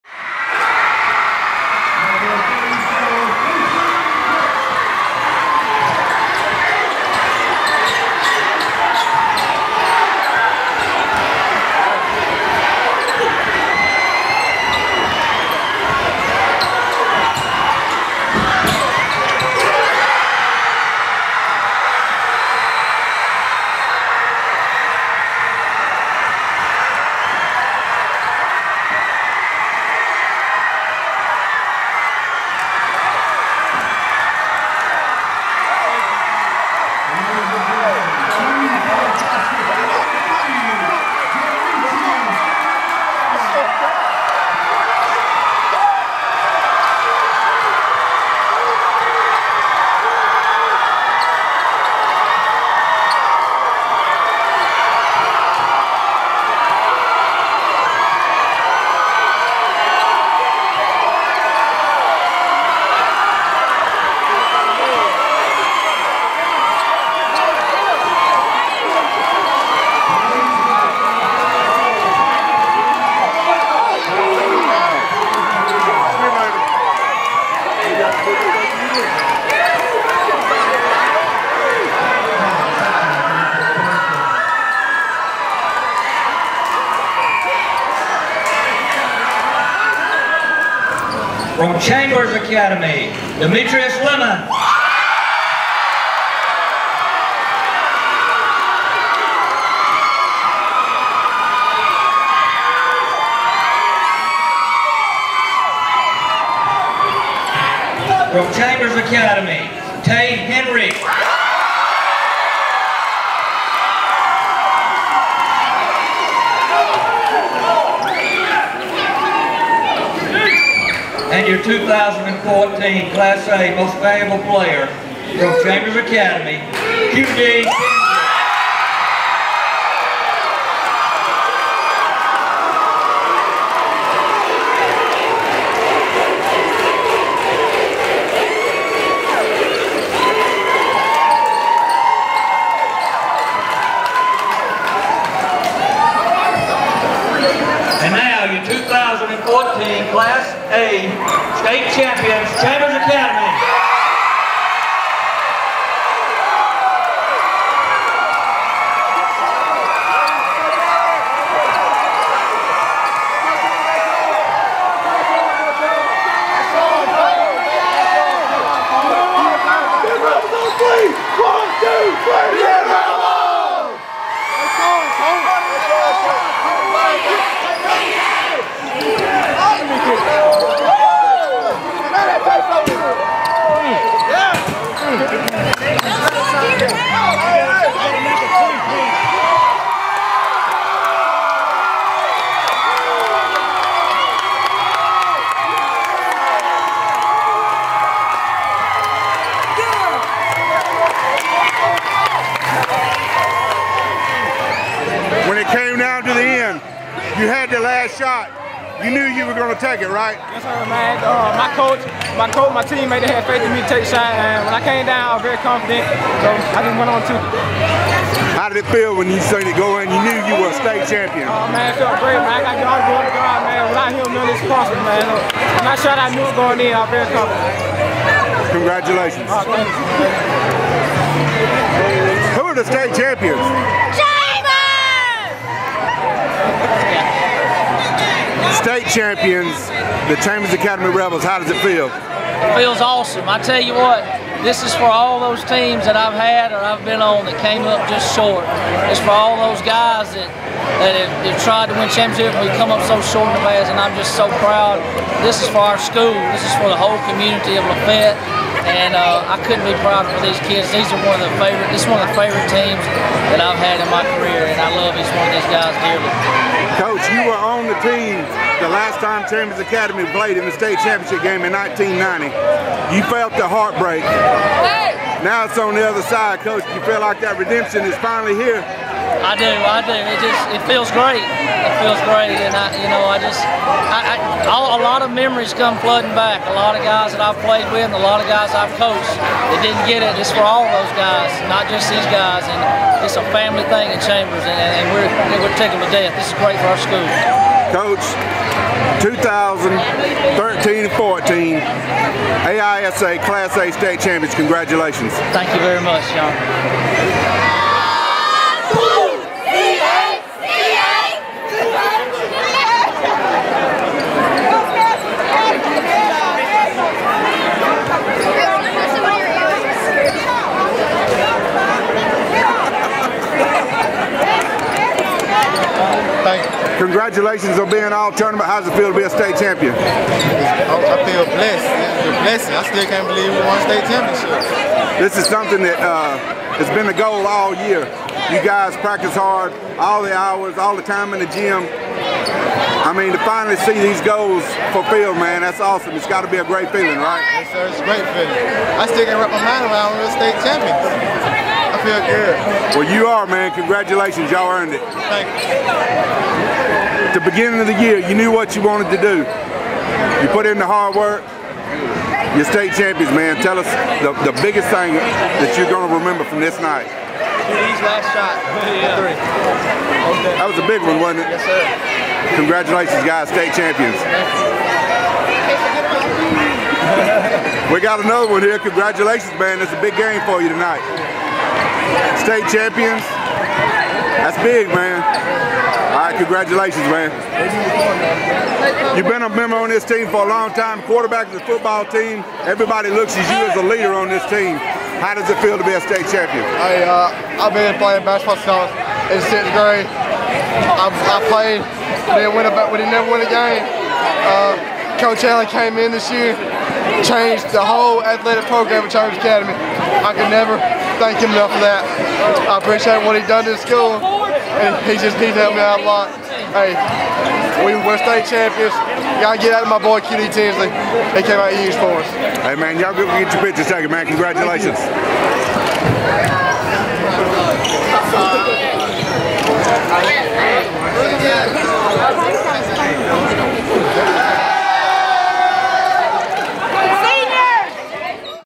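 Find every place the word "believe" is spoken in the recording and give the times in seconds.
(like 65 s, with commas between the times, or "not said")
333 s.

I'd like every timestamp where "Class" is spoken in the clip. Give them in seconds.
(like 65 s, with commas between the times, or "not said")
123 s, 303 s.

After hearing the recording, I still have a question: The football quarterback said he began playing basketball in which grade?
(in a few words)
Sixth grade.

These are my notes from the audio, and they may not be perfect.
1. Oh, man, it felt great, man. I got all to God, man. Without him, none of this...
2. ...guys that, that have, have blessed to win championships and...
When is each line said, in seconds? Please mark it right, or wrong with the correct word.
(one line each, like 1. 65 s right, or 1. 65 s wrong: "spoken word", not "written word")
1. 221 s right
2. 249 s wrong: "tried", not "blessed".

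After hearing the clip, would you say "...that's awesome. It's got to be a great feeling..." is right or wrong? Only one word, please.
right.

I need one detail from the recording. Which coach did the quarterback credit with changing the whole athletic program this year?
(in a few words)
Coach Allen.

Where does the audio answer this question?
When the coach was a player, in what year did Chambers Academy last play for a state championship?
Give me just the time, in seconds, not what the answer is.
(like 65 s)
271 s.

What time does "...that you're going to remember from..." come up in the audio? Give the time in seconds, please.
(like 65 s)
365 s.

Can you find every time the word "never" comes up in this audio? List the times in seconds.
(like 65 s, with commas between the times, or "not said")
403 s, 410 s.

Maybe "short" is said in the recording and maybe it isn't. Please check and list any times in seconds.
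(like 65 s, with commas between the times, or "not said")
248 s, 253 s.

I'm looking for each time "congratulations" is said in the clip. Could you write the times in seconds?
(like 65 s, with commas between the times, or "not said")
228 s, 304 s, 327 s, 353 s, 372 s, 378 s, 386 s, 424 s.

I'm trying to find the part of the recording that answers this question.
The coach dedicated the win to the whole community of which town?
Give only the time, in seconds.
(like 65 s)
257 s.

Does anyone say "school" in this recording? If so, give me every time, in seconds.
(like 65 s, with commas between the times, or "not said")
255 s, 297 s, 413 s.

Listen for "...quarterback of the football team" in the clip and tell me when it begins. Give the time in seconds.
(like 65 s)
391 s.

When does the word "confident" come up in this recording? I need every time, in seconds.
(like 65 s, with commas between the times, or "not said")
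215 s, 227 s.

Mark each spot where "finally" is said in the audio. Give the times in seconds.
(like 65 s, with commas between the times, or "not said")
278 s, 343 s.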